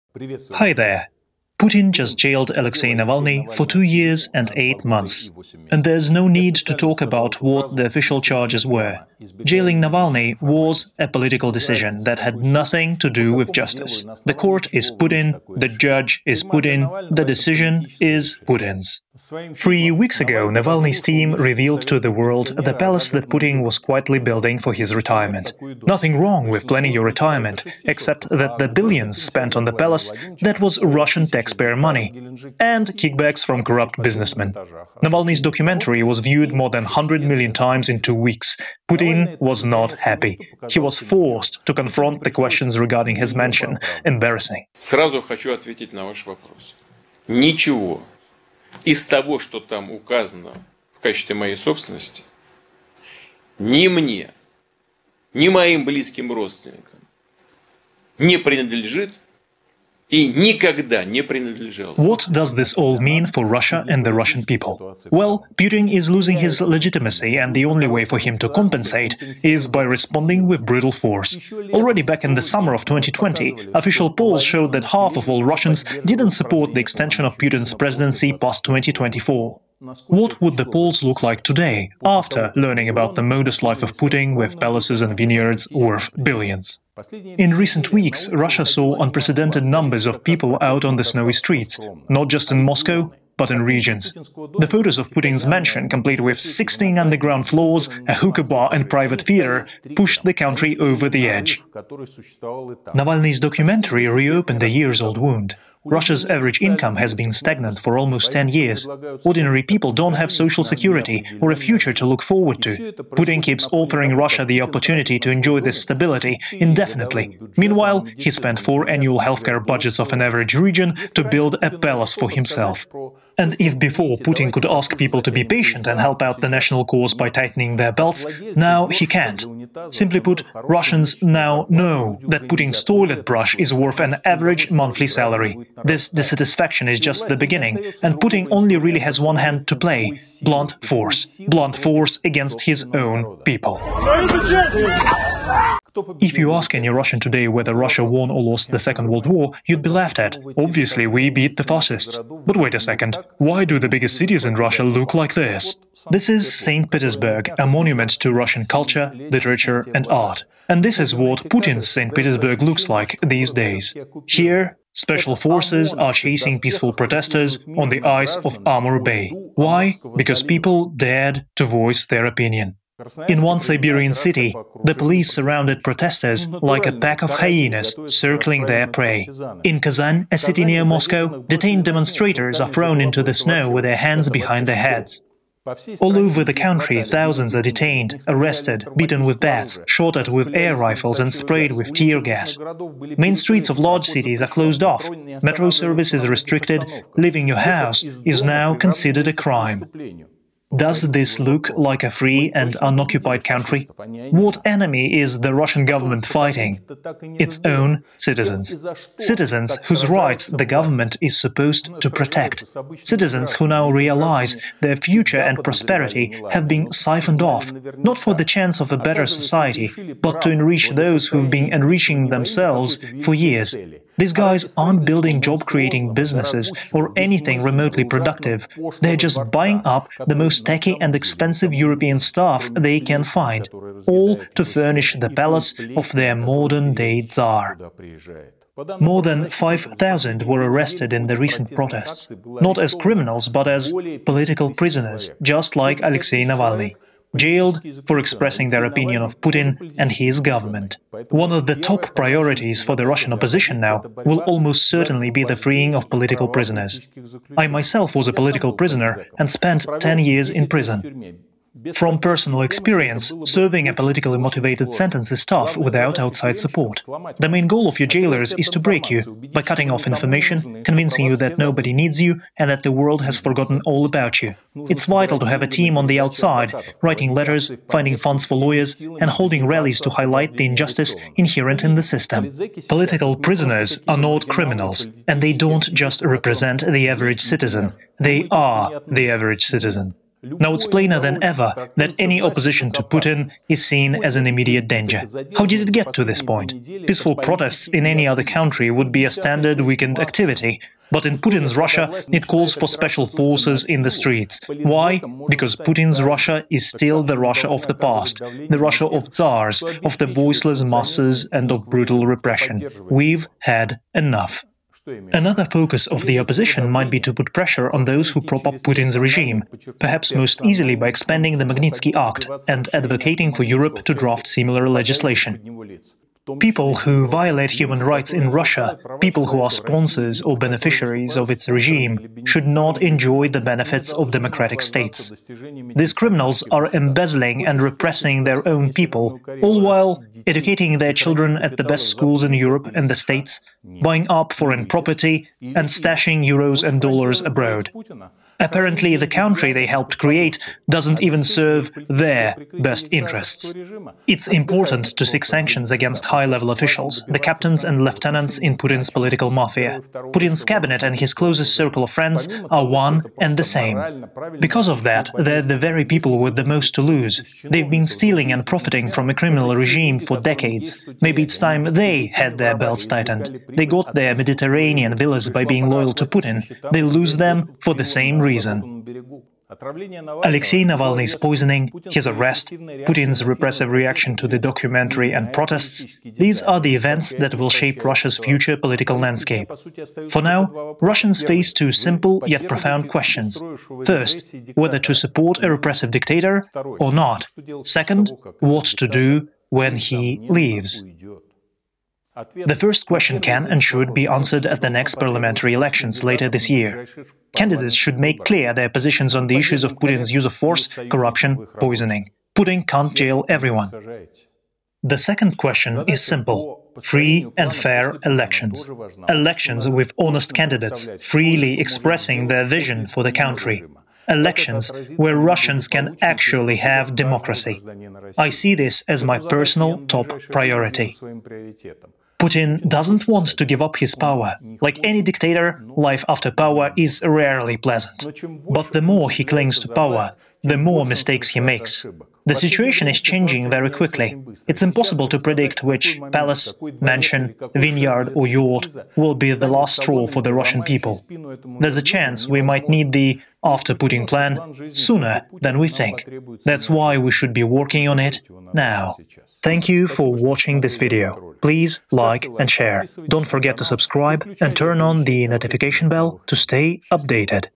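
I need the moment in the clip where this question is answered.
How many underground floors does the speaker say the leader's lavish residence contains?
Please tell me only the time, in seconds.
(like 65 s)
96 s.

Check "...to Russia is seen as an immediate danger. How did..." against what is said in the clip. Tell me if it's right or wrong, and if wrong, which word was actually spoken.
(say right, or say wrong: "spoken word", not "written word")
wrong: "Putin", not "Russia".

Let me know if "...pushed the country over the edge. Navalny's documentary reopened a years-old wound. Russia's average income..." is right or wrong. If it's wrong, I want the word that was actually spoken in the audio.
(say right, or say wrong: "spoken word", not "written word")
right.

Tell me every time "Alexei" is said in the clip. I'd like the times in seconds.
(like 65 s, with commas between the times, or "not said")
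2 s, 246 s, 380 s.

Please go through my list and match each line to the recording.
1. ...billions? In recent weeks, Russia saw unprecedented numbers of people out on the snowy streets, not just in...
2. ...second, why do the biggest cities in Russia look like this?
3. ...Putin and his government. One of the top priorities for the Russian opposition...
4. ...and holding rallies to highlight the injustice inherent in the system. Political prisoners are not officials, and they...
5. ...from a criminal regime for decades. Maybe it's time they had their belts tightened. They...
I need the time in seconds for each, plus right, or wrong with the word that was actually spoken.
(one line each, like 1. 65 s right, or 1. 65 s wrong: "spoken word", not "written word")
1. 86 s right
2. 152 s right
3. 249 s right
4. 278 s wrong: "criminals", not "officials"
5. 369 s right.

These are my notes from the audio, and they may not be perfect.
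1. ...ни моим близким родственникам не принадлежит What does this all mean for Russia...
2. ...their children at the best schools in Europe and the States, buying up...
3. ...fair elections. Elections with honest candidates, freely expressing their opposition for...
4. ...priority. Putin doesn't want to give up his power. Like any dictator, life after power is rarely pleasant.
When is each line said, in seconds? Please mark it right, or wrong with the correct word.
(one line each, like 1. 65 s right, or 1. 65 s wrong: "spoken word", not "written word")
1. 55 s right
2. 340 s right
3. 417 s wrong: "vision", not "opposition"
4. 430 s right.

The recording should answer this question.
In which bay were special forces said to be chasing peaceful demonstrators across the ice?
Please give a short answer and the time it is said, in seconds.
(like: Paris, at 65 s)
Amur Bay, at 168 s.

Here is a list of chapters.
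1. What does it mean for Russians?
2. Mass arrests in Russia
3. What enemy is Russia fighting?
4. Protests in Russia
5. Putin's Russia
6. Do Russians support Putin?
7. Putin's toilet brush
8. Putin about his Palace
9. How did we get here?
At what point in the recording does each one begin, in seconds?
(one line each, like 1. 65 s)
1. 62 s
2. 239 s
3. 204 s
4. 87 s
5. 160 s
6. 75 s
7. 130 s
8. 44 s
9. 295 s.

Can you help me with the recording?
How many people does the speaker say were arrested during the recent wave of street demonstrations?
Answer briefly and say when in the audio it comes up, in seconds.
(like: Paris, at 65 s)
more than 5,000, at 238 s.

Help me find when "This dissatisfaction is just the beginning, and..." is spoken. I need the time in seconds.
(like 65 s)
135 s.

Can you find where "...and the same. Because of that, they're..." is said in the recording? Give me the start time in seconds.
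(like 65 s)
363 s.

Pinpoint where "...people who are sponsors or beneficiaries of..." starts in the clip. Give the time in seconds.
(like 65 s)
329 s.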